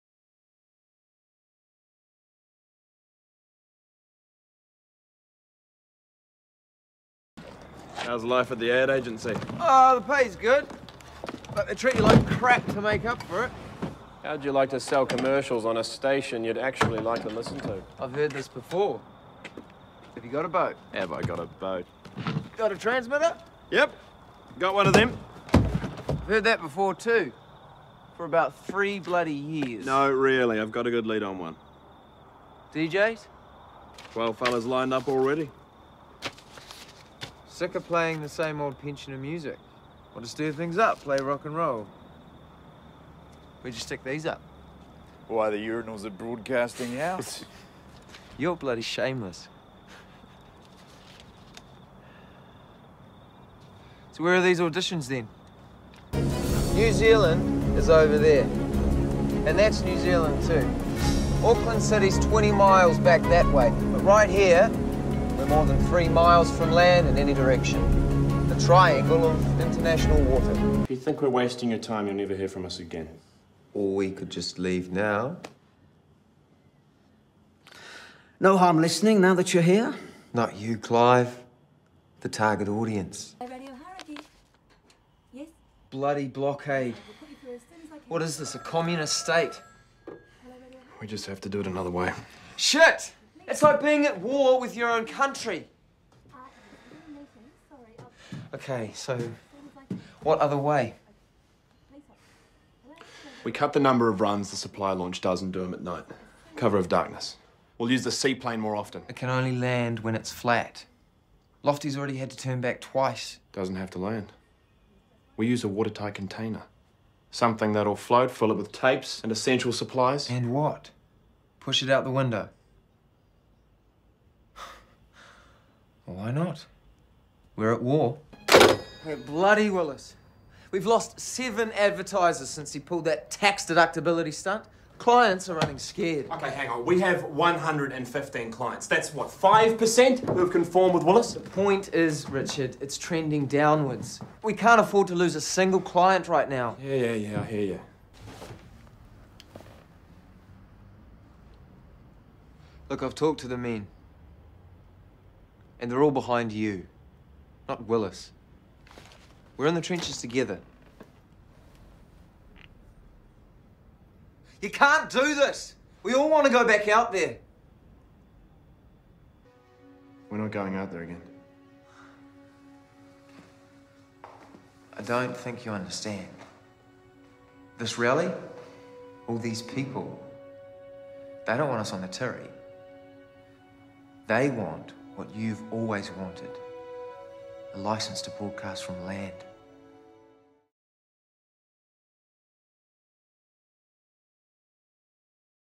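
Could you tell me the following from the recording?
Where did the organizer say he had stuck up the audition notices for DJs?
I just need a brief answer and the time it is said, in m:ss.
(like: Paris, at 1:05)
Broadcasting House, at 0:46.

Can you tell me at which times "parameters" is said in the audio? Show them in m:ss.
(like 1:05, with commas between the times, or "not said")
not said.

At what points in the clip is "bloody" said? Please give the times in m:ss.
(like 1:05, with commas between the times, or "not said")
0:28, 0:48, 1:25, 2:09.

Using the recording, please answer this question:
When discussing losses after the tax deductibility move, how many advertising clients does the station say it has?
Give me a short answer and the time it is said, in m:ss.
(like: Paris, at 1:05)
115, at 2:17.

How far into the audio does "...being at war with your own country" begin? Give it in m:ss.
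1:33.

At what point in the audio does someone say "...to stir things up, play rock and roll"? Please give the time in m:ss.
0:40.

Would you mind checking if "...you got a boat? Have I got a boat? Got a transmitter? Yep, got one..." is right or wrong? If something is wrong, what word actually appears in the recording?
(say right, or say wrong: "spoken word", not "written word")
right.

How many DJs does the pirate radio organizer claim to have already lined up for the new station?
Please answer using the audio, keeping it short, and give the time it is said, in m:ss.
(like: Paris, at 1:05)
12, at 0:34.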